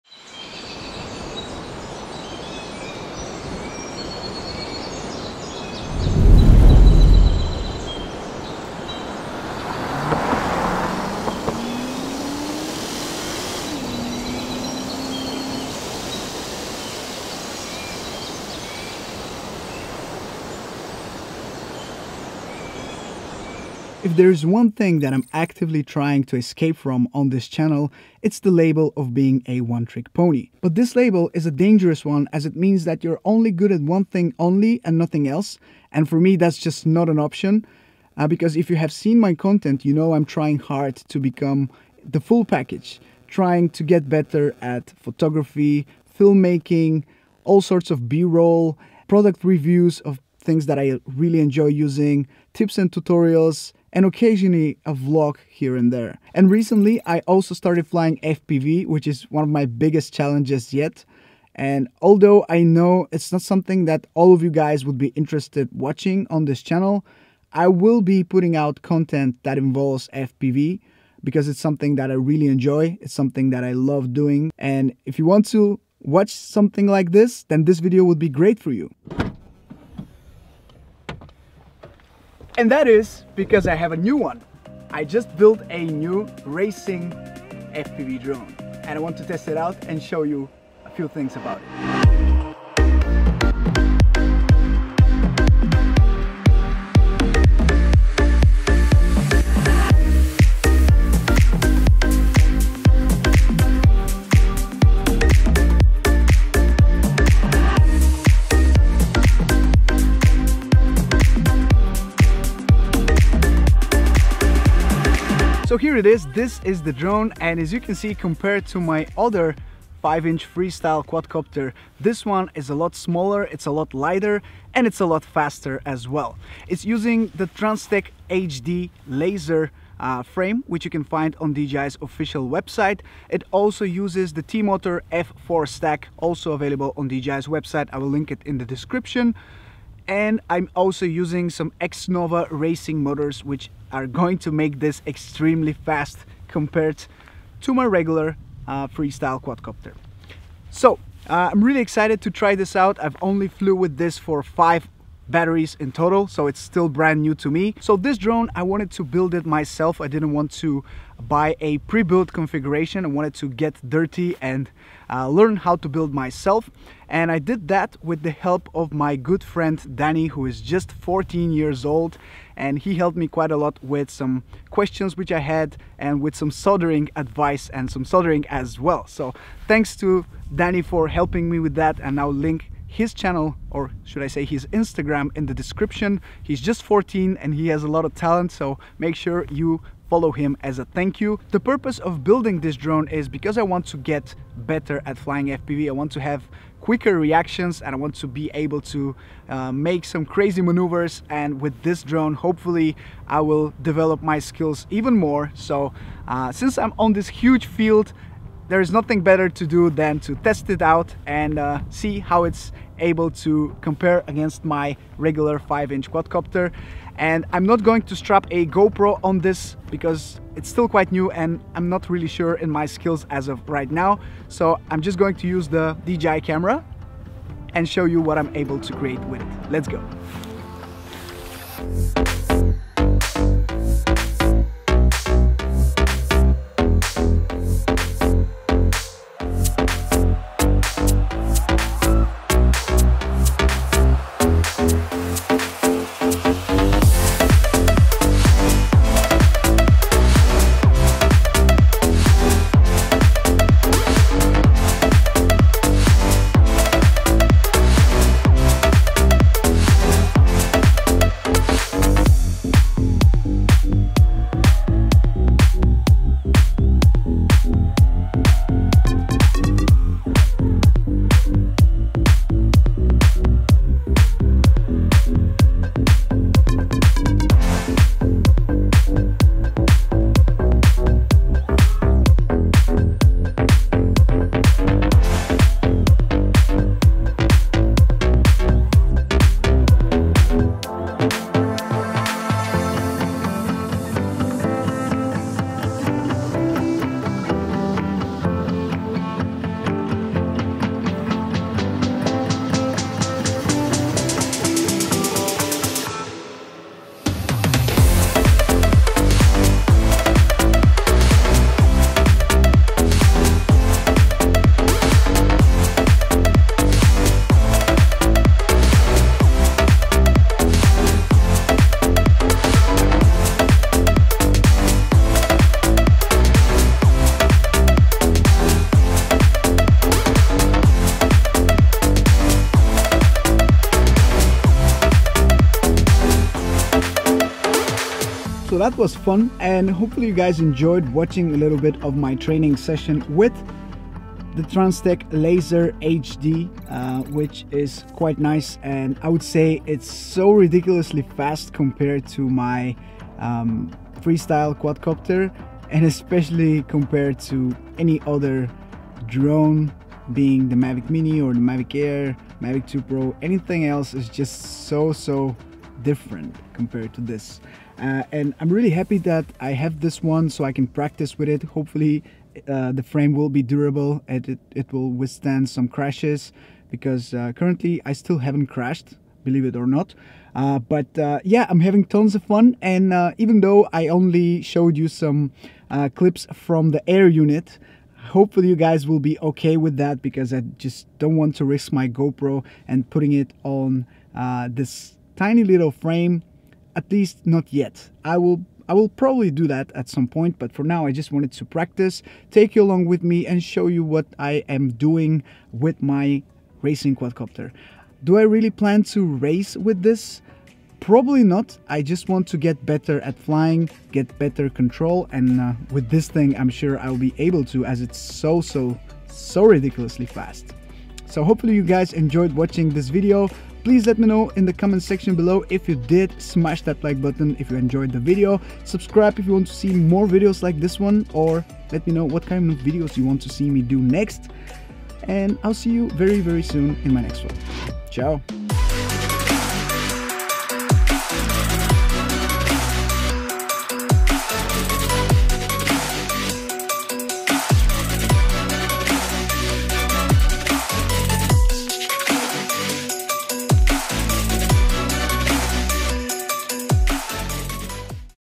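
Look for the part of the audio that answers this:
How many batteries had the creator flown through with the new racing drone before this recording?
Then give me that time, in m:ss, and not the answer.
2:34.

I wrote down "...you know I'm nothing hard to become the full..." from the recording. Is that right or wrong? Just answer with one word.
wrong.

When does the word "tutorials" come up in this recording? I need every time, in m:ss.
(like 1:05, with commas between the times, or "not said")
0:52.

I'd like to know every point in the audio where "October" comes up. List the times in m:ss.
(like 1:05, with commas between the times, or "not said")
not said.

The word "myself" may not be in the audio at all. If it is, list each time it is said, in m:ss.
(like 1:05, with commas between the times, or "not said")
2:39, 2:46.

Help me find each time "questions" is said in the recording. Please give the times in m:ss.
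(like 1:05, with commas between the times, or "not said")
2:54.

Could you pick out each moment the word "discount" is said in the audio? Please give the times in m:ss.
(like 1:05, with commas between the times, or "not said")
not said.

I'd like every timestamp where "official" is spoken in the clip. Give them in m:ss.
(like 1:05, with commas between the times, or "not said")
2:12.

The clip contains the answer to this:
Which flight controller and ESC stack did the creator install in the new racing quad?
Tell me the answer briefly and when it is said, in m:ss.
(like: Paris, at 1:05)
T-Motor F4 stack, at 2:14.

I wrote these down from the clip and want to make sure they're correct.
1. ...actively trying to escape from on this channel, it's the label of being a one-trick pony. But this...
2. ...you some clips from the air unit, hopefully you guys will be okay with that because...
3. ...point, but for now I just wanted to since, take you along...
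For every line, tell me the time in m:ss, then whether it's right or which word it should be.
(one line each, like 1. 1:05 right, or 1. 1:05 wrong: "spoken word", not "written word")
1. 0:25 right
2. 6:24 right
3. 6:40 wrong: "practice", not "since".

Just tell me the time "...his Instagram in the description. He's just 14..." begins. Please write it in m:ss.
3:04.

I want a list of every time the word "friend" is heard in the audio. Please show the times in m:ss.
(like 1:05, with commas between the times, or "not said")
2:49.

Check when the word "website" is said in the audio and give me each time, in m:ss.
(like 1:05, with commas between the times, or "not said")
2:12, 2:17.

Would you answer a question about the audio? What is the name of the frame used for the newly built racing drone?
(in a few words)
Transtec HD laser.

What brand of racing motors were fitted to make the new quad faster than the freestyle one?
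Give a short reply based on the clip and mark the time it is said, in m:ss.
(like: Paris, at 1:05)
X-Nova, at 2:21.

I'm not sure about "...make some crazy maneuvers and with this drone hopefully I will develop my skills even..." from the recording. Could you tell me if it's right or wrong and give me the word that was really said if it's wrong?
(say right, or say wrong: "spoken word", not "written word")
right.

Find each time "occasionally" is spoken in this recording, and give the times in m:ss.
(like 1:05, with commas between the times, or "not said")
0:54.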